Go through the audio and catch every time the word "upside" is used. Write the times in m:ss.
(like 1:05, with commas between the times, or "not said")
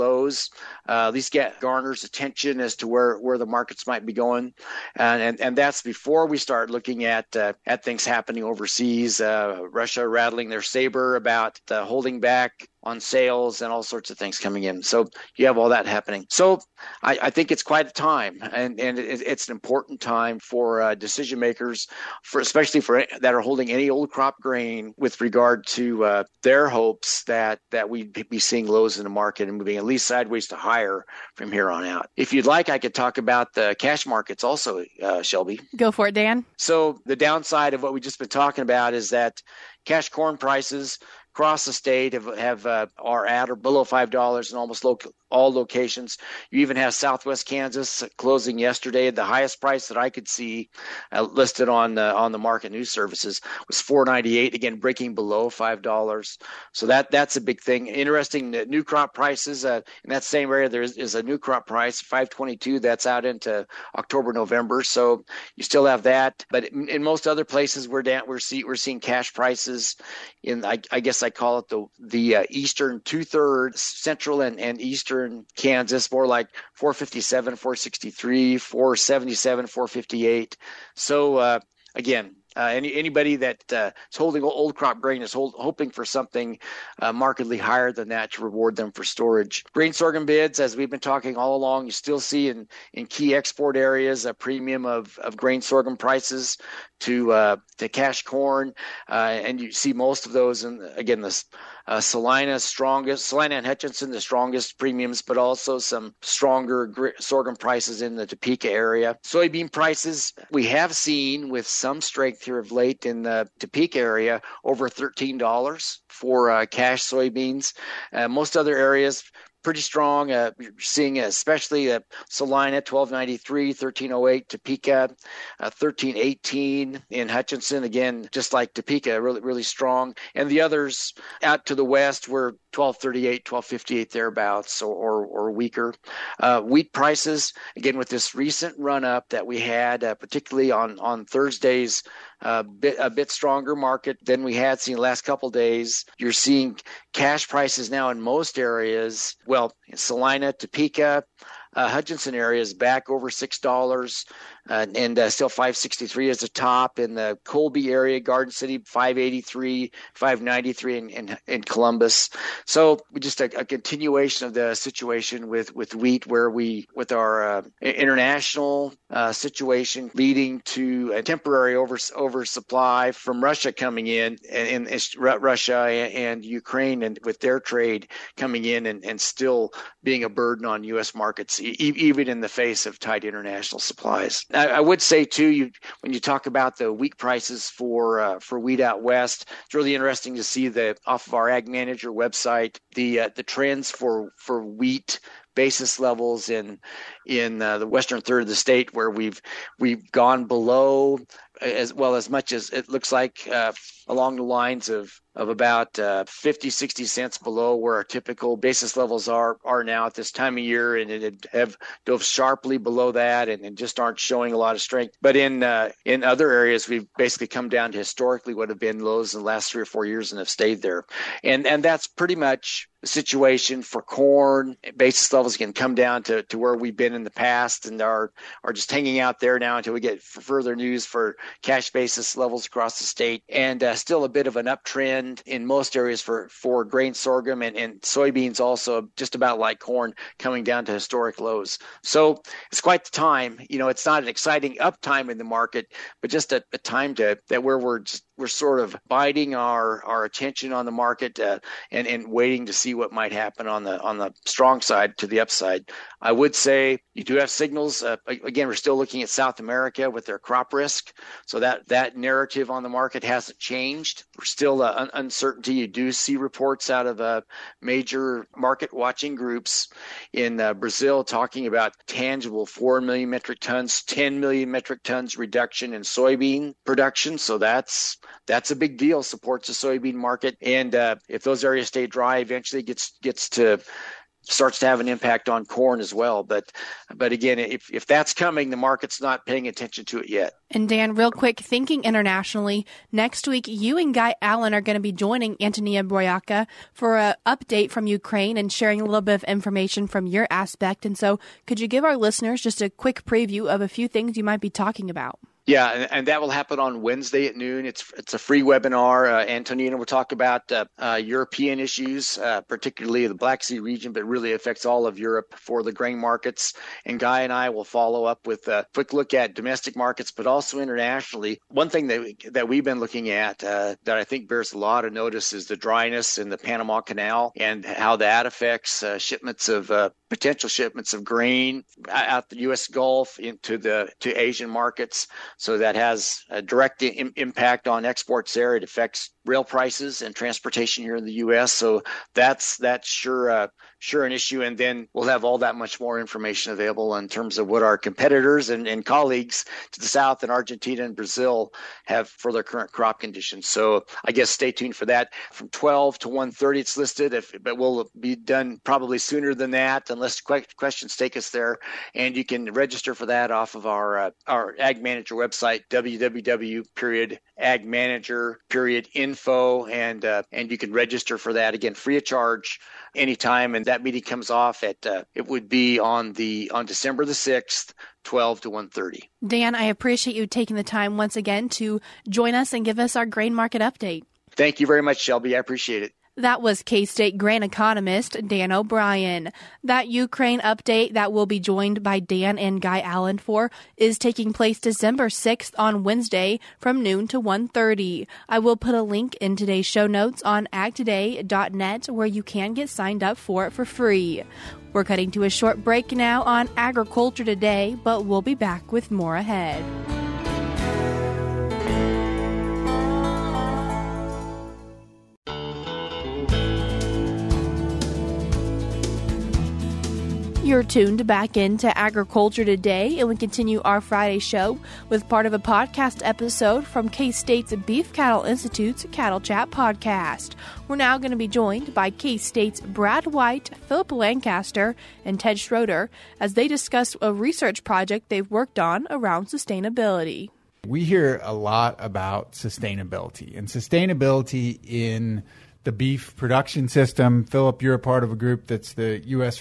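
4:15.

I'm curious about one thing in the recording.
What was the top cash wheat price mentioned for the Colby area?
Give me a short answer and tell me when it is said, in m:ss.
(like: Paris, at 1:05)
$5.63, at 2:35.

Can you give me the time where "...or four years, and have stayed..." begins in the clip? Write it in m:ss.
3:39.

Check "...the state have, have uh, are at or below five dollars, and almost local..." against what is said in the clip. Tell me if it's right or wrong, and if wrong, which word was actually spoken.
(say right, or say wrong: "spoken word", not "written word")
right.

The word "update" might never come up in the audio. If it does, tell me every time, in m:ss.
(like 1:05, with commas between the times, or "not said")
4:57, 6:23, 6:30.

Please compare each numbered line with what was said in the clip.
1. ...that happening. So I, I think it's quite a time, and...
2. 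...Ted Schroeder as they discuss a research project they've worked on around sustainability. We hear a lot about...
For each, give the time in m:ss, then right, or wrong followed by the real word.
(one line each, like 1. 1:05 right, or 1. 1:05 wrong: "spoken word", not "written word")
1. 0:15 right
2. 7:15 right.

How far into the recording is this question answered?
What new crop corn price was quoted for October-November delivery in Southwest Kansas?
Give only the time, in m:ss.
1:02.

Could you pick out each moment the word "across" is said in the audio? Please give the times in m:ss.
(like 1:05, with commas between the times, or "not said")
0:41, 3:52.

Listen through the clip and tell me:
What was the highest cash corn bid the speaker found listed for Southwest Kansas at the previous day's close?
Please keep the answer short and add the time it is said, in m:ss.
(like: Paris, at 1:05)
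$4.98, at 0:53.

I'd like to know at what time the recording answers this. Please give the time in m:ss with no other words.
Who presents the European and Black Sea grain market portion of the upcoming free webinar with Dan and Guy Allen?
4:55.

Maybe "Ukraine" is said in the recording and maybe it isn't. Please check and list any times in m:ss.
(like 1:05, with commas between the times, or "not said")
2:56, 4:58, 6:30.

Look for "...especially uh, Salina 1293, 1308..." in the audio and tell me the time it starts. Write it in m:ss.
2:01.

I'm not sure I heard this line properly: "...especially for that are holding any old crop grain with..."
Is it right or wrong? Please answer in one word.
right.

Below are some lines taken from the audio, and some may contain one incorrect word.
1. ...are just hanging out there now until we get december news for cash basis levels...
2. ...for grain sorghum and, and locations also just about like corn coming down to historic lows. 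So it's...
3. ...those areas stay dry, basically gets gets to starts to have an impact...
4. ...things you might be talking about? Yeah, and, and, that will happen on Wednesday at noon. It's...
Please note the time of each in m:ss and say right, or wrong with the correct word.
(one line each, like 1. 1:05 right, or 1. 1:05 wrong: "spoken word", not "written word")
1. 3:48 wrong: "further", not "december"
2. 3:56 wrong: "soybeans", not "locations"
3. 4:41 wrong: "eventually", not "basically"
4. 5:04 right.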